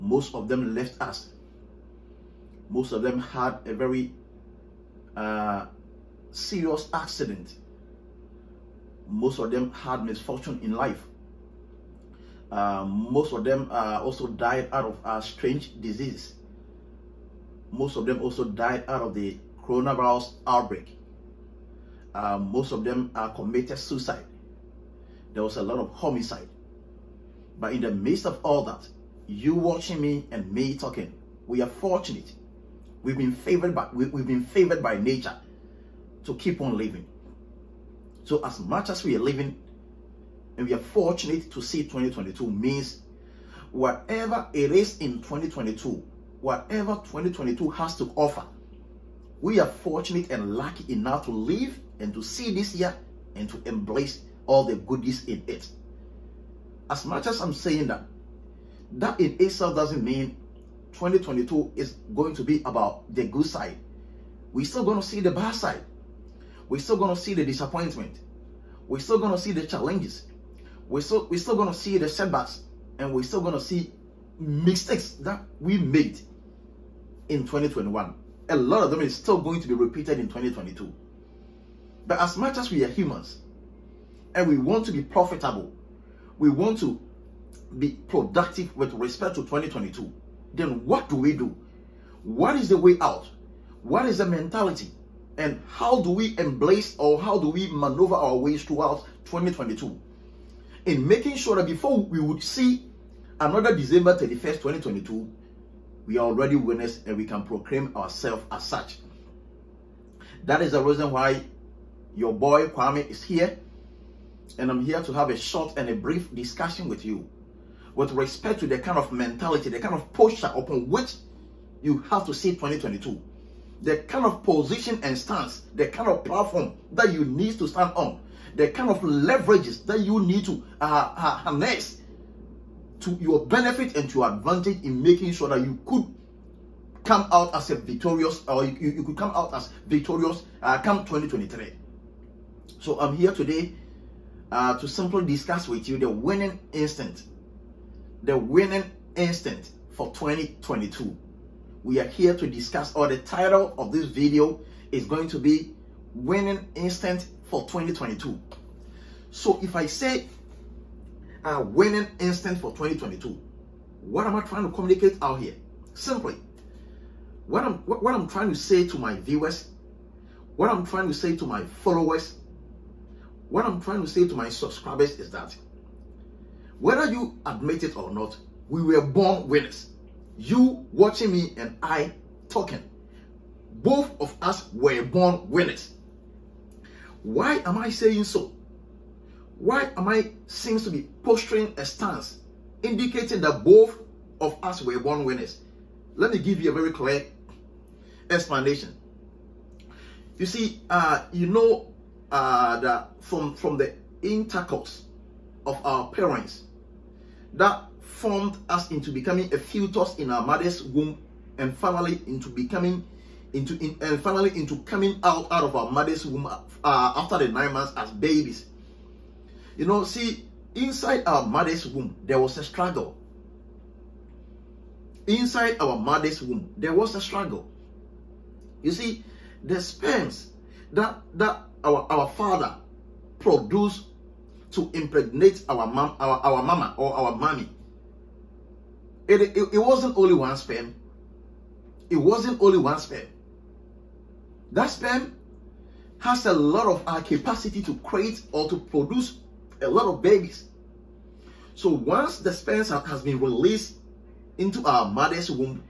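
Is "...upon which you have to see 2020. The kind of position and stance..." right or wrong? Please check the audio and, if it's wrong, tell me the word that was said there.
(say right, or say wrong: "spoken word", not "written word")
wrong: "2022", not "2020".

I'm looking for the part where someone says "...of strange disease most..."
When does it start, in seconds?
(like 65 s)
15 s.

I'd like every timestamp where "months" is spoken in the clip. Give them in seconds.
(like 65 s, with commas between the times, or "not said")
217 s.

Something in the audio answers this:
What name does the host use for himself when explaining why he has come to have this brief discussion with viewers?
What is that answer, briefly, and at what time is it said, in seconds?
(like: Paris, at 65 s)
Kwame, at 112 s.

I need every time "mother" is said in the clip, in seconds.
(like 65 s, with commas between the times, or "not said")
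210 s, 215 s, 221 s, 225 s, 255 s.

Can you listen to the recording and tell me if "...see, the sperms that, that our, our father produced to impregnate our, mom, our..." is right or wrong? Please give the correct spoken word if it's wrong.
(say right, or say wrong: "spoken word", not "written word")
right.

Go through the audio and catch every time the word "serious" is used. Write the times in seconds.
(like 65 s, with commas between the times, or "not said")
6 s.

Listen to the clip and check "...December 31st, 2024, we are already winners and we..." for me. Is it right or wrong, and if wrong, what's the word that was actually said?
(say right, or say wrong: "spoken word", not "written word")
wrong: "2022", not "2024".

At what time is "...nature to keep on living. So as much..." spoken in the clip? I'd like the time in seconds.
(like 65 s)
34 s.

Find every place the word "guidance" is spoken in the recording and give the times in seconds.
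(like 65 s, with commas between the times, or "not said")
not said.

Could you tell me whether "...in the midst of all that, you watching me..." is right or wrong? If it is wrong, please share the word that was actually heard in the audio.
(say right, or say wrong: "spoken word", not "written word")
right.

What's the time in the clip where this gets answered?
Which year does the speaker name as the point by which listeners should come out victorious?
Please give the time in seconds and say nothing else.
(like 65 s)
140 s.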